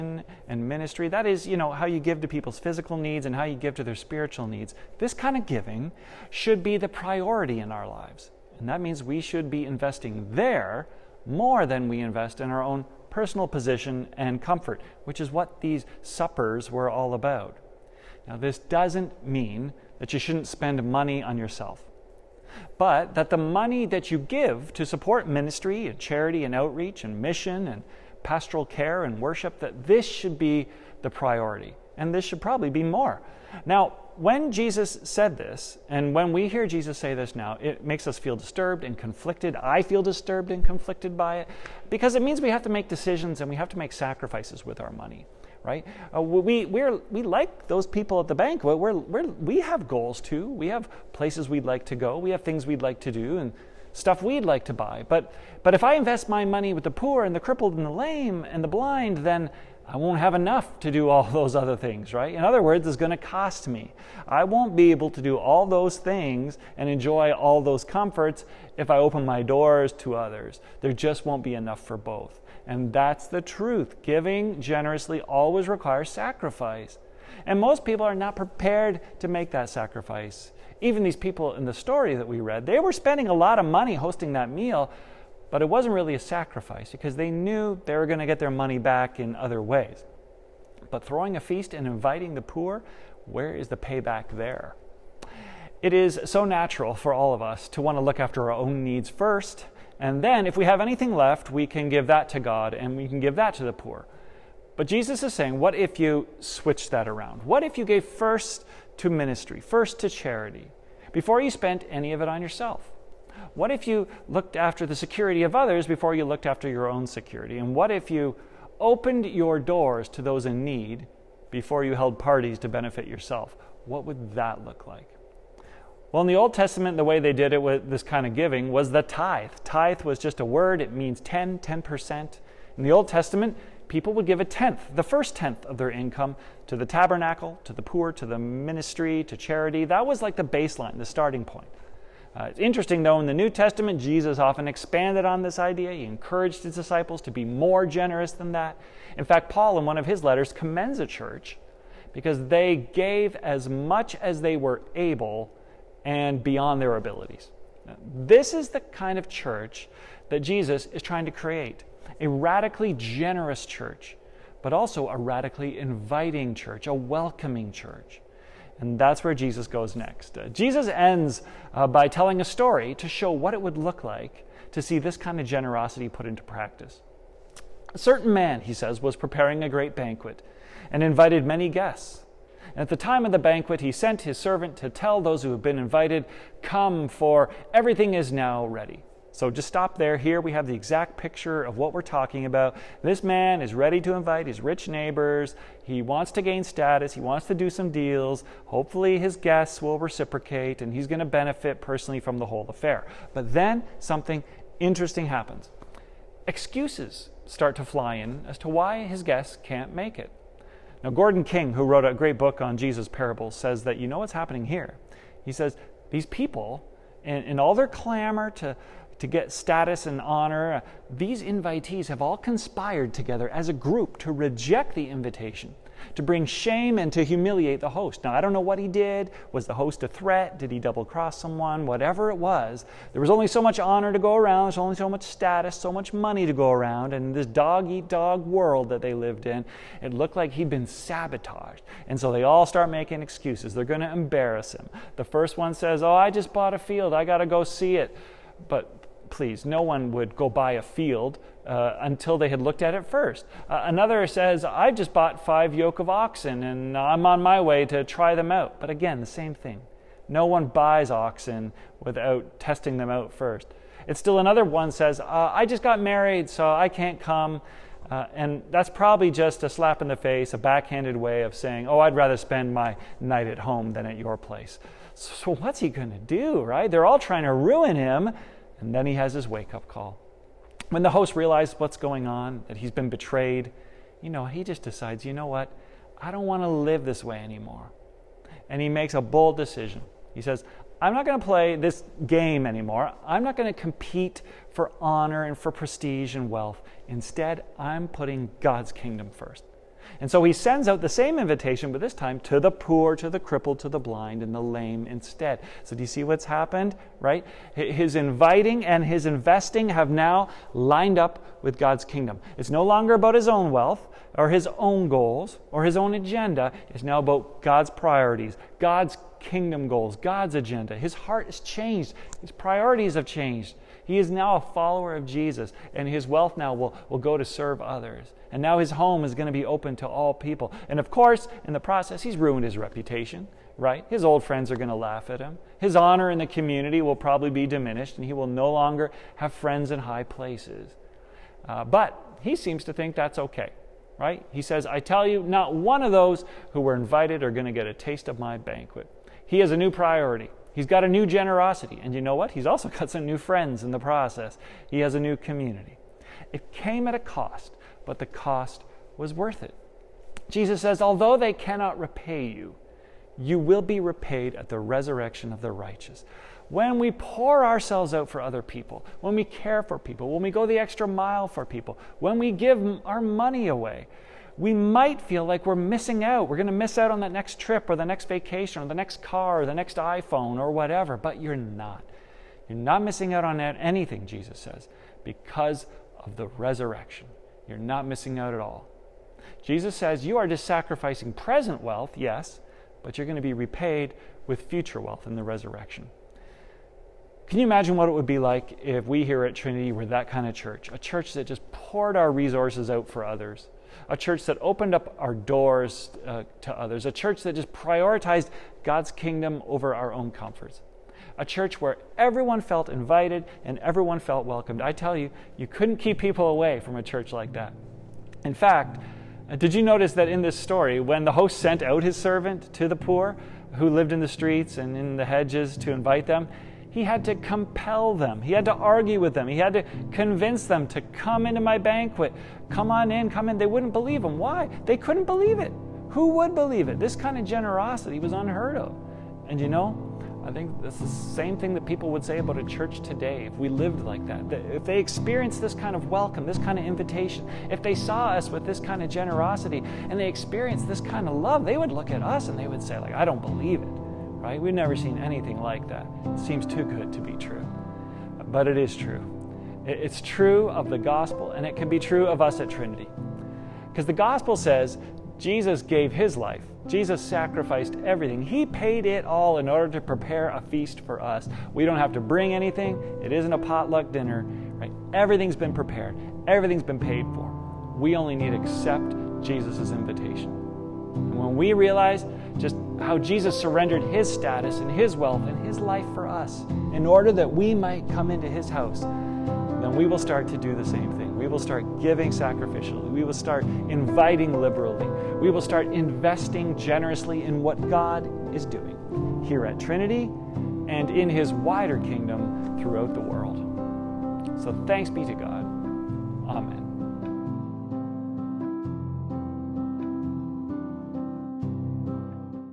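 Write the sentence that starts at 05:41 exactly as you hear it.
Uh, but he seems to think that's okay, right?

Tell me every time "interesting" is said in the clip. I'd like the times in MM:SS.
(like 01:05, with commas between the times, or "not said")
02:22, 03:24.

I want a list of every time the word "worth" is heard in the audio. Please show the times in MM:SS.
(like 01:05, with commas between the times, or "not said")
05:59.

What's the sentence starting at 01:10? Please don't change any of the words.
There just won't be enough for both.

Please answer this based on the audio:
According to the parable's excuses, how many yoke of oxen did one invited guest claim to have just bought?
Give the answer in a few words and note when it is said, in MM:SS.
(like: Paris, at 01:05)
5, at 04:15.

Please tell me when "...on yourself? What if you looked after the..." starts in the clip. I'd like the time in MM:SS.
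01:52.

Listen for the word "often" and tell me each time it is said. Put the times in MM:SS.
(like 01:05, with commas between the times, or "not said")
02:24.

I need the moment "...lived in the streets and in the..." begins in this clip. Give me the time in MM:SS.
07:03.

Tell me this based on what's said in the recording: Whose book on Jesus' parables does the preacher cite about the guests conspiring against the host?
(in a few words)
Gordon King.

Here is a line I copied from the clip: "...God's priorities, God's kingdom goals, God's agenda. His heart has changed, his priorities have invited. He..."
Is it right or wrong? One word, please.
wrong.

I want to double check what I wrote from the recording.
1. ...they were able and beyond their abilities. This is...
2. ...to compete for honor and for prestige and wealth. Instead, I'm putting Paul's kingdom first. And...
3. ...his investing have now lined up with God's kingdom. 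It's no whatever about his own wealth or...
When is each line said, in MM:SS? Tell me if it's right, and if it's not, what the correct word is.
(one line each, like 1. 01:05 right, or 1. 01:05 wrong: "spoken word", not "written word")
1. 02:34 right
2. 04:53 wrong: "God", not "Paul"
3. 05:09 wrong: "longer", not "whatever".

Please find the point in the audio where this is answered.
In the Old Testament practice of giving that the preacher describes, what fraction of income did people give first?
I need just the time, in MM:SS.
02:14.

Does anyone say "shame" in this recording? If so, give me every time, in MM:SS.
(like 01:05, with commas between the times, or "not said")
03:46.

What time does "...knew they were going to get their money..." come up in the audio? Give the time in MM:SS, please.
01:27.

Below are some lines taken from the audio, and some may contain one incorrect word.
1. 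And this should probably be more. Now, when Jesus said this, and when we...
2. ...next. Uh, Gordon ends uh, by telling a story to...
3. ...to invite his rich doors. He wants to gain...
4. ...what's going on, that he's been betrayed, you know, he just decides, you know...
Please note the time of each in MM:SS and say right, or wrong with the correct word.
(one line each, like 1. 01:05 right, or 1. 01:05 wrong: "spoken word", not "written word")
1. 00:31 right
2. 02:49 wrong: "Jesus", not "Gordon"
3. 03:14 wrong: "neighbors", not "doors"
4. 04:41 right.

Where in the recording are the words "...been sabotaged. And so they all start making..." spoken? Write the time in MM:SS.
04:00.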